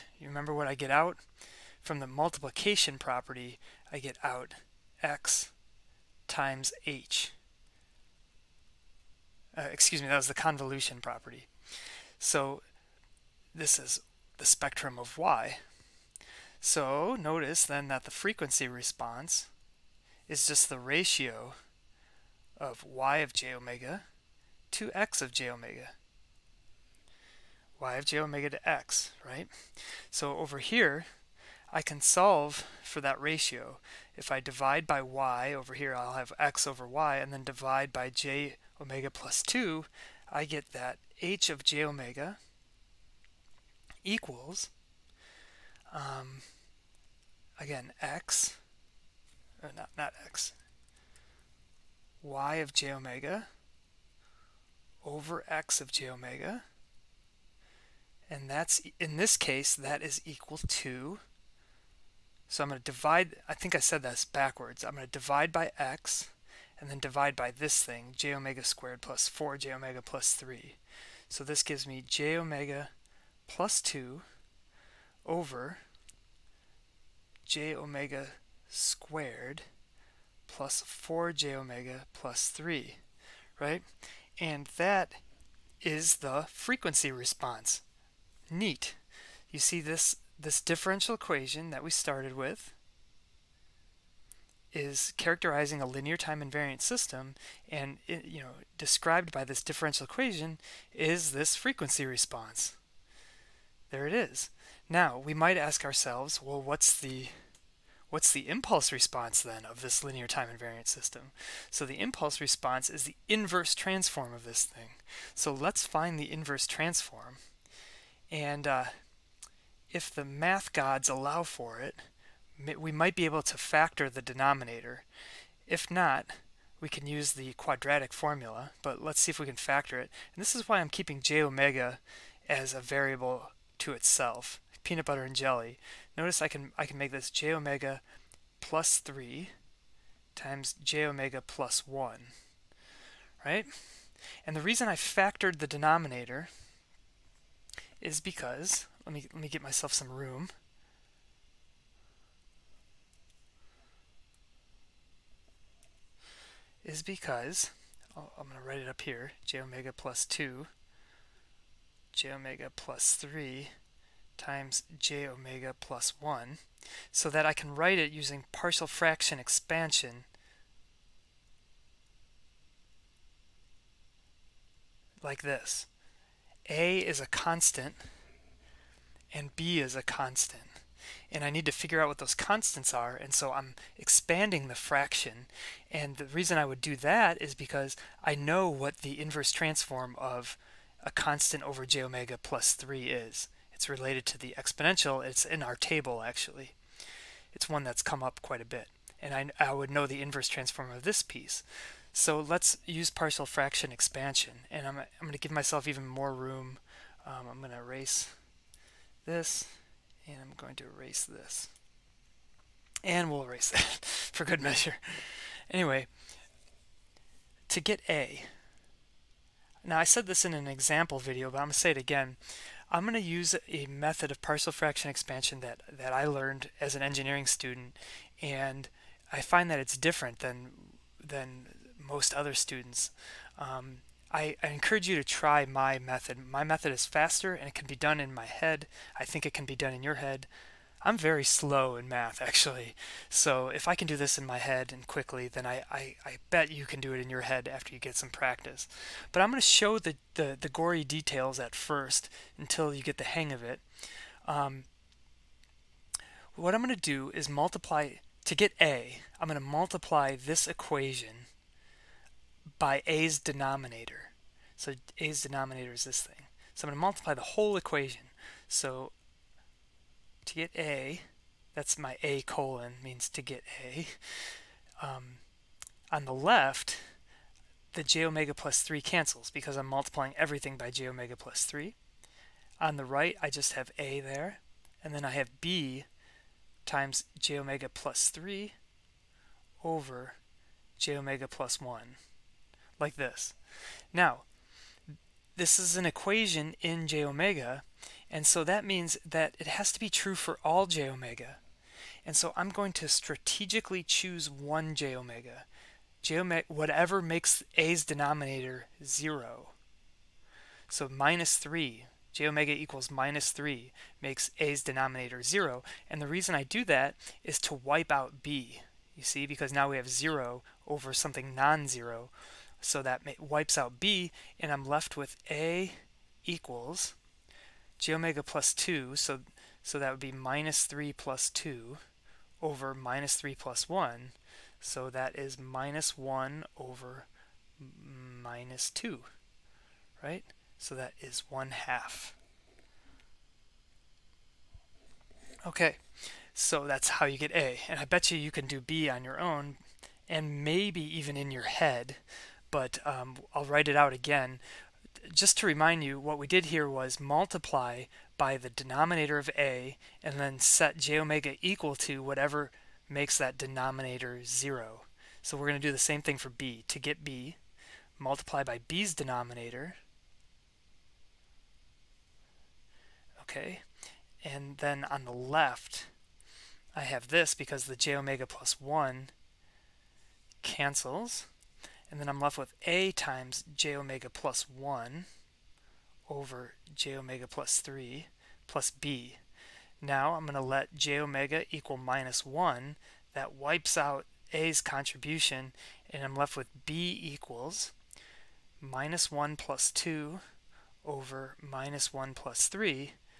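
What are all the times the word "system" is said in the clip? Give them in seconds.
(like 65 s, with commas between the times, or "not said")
96 s, 110 s.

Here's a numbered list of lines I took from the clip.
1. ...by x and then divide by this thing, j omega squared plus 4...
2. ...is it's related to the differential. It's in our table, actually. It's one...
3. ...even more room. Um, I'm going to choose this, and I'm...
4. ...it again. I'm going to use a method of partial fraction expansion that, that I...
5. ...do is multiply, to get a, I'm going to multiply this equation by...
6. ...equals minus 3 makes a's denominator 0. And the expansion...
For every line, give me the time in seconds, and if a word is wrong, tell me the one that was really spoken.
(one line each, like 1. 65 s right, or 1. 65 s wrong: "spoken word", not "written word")
1. 65 s right
2. 193 s wrong: "exponential", not "differential"
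3. 205 s wrong: "erase", not "choose"
4. 221 s right
5. 257 s right
6. 312 s wrong: "reason", not "expansion".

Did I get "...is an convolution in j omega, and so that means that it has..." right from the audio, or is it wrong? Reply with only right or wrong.
wrong.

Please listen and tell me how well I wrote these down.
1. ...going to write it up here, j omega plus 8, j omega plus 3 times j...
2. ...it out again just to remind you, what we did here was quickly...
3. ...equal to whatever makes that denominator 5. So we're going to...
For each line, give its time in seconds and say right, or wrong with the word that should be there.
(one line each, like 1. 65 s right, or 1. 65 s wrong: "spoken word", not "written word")
1. 158 s wrong: "2", not "8"
2. 353 s wrong: "multiply", not "quickly"
3. 361 s wrong: "0", not "5".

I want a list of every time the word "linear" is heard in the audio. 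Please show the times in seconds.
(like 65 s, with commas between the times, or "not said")
95 s, 110 s.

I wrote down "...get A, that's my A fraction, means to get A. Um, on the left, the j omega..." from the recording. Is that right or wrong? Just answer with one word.
wrong.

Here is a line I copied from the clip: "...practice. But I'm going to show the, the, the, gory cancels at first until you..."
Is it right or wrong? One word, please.
wrong.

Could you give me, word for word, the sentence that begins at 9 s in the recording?
Uh, excuse me, that was the convolution property.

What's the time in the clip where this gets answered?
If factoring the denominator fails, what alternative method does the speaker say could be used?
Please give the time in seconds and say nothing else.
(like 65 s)
127 s.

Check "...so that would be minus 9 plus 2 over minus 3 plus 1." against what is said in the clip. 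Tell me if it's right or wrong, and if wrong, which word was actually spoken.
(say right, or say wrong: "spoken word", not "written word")
wrong: "3", not "9".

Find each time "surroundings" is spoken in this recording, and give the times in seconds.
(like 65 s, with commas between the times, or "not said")
not said.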